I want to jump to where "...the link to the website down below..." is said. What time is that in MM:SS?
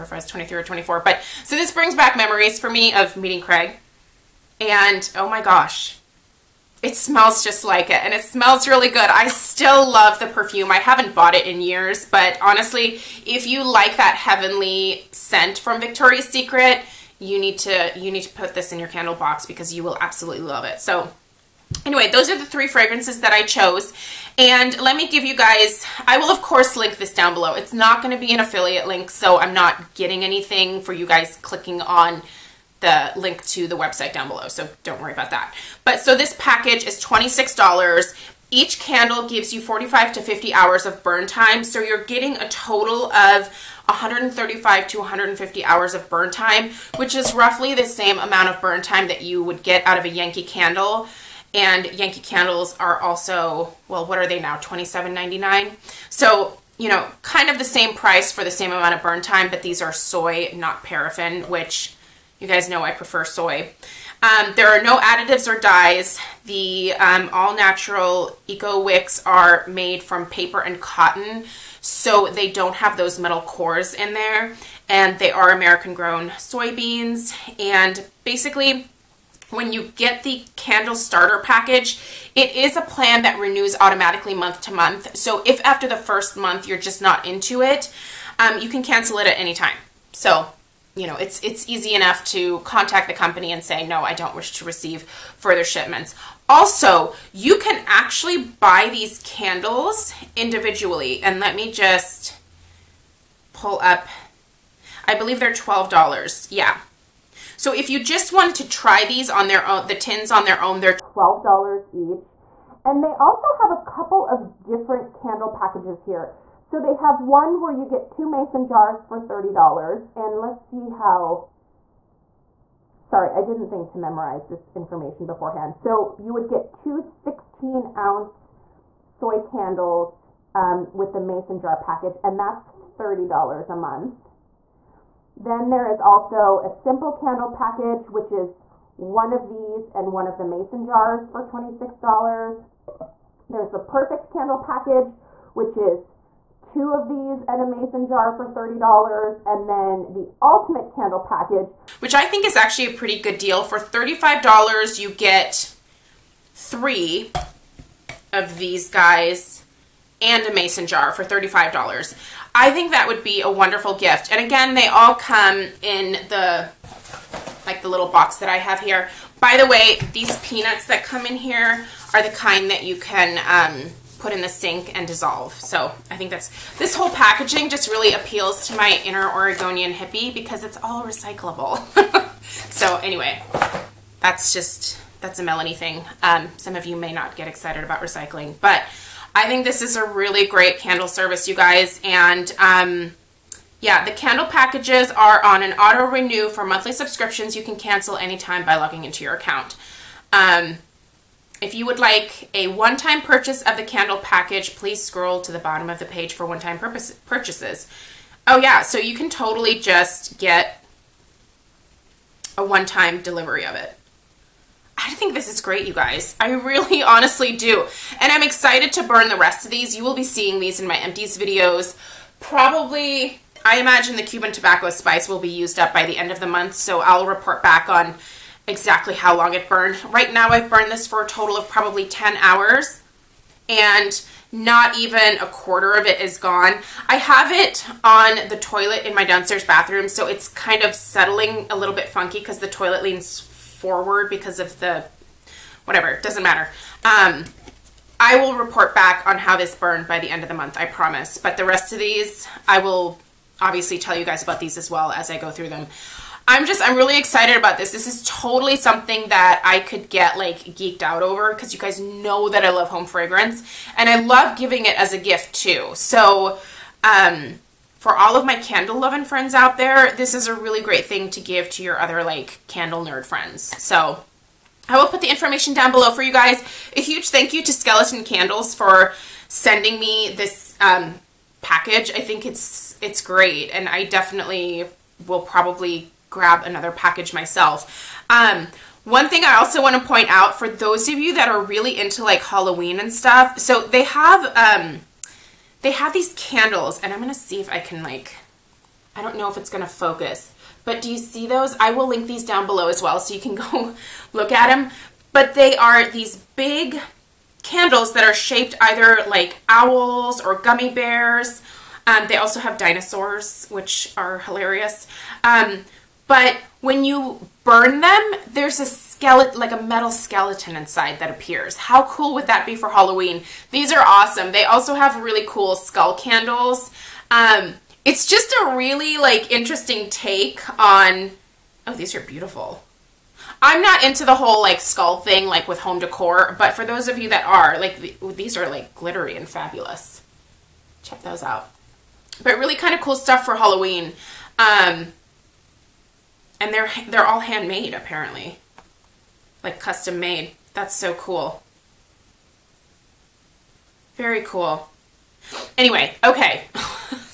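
00:32.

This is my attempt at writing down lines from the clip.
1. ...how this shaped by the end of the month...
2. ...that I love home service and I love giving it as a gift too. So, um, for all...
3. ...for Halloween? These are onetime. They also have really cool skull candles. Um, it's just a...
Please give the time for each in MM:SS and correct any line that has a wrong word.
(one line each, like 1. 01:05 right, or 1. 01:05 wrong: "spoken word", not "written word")
1. 04:09 wrong: "burned", not "shaped"
2. 04:22 wrong: "fragrance", not "service"
3. 05:22 wrong: "awesome", not "onetime".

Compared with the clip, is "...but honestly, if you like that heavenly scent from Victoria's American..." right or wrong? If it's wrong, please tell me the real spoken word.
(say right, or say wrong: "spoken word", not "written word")
wrong: "Secret", not "American".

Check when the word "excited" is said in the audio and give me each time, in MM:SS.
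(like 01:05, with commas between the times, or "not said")
03:07, 03:38, 04:17.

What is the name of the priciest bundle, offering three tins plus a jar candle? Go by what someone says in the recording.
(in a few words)
ultimate candle package.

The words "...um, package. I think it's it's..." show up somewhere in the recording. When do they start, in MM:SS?
04:40.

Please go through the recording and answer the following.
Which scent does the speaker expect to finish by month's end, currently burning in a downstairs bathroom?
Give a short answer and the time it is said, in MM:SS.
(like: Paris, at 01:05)
Cuban tobacco spice, at 03:44.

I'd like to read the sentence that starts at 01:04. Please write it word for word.
Um, there are no additives or dyes.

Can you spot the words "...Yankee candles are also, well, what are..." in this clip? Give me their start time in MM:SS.
00:51.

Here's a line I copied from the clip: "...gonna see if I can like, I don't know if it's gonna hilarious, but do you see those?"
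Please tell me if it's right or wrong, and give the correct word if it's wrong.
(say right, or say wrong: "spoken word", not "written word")
wrong: "focus", not "hilarious".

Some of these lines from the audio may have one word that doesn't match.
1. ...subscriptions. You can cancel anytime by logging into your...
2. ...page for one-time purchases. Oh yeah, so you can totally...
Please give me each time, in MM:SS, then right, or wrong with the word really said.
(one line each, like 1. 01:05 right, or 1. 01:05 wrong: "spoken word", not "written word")
1. 03:16 right
2. 03:26 right.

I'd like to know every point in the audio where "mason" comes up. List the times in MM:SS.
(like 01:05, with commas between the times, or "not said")
01:58, 02:11, 02:20, 02:27, 02:40.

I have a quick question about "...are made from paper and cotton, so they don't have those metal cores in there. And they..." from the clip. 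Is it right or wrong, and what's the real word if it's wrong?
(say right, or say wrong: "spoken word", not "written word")
right.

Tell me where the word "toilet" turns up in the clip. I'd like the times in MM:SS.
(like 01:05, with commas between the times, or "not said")
03:58, 04:02.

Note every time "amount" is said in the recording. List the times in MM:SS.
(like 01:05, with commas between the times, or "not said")
00:48, 00:58.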